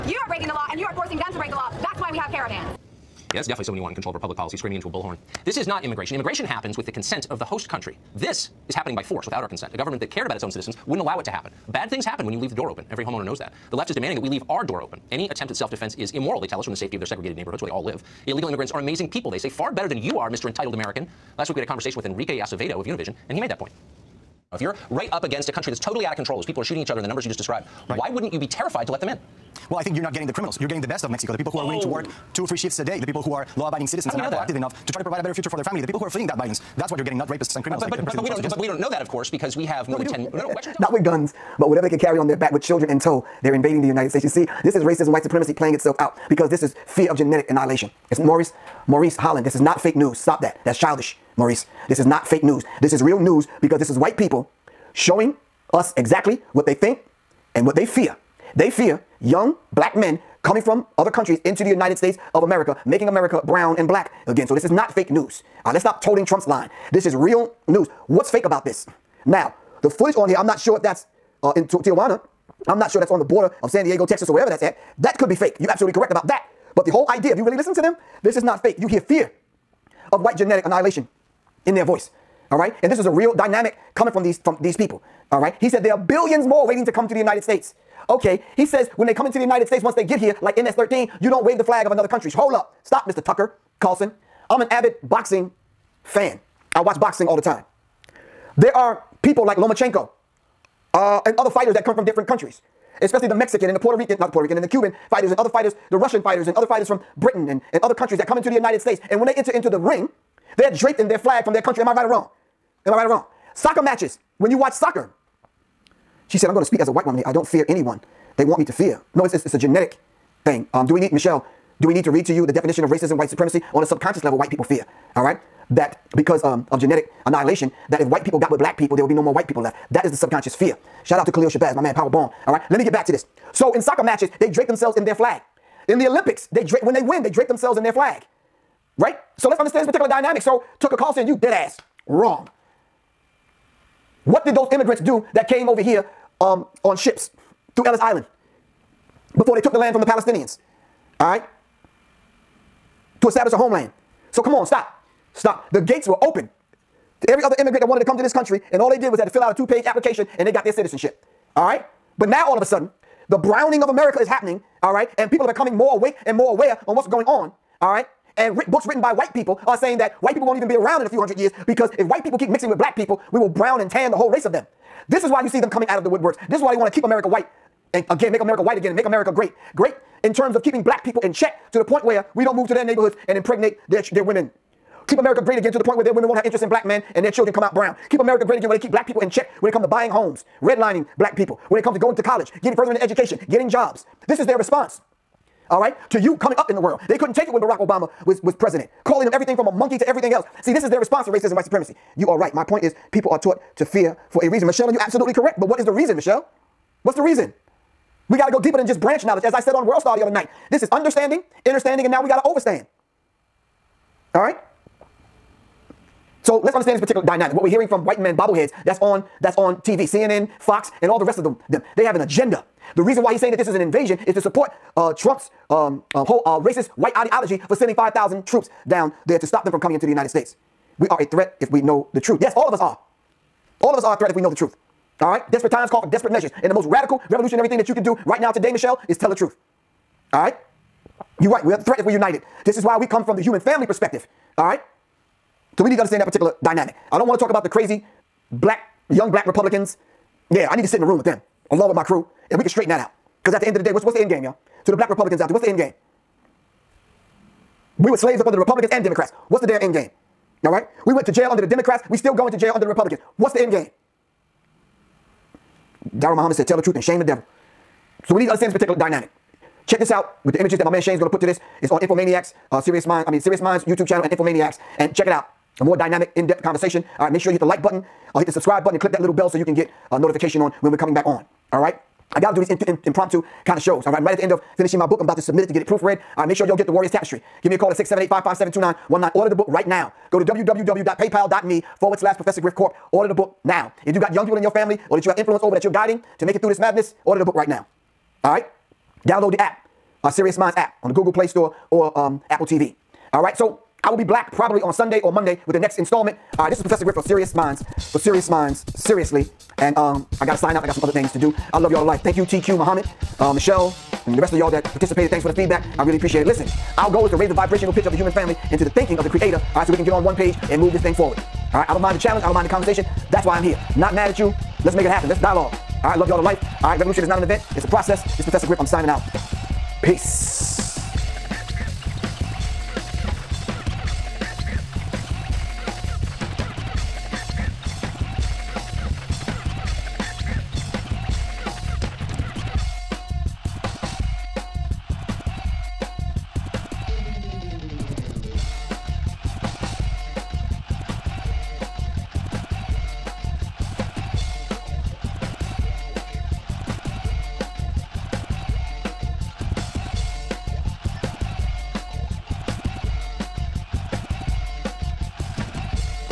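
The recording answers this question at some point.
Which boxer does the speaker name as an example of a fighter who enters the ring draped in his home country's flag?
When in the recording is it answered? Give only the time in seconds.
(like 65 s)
99 s.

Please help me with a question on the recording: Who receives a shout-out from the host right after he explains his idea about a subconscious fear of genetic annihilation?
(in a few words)
Khalil Shabazz.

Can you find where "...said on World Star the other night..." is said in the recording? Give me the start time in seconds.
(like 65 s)
209 s.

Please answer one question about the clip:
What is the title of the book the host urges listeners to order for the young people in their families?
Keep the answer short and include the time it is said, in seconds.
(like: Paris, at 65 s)
Warriors Tapestry, at 286 s.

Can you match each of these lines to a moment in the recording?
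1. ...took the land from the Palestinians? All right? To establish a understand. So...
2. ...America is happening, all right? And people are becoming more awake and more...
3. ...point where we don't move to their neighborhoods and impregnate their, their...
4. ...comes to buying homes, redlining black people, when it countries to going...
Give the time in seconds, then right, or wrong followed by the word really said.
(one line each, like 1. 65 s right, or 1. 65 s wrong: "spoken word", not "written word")
1. 149 s wrong: "homeland", not "understand"
2. 163 s right
3. 181 s right
4. 189 s wrong: "comes", not "countries".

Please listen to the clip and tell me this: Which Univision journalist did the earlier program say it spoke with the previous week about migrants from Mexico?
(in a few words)
Enrique Acevedo.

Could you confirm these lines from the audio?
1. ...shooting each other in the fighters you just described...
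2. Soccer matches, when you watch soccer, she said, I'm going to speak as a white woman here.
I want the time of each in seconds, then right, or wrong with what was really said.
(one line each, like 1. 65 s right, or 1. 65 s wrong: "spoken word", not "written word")
1. 26 s wrong: "numbers", not "fighters"
2. 113 s right.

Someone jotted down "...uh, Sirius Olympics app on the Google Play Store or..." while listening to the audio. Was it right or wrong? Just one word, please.
wrong.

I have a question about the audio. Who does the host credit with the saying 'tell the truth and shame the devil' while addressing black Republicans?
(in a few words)
Daryl Muhammad.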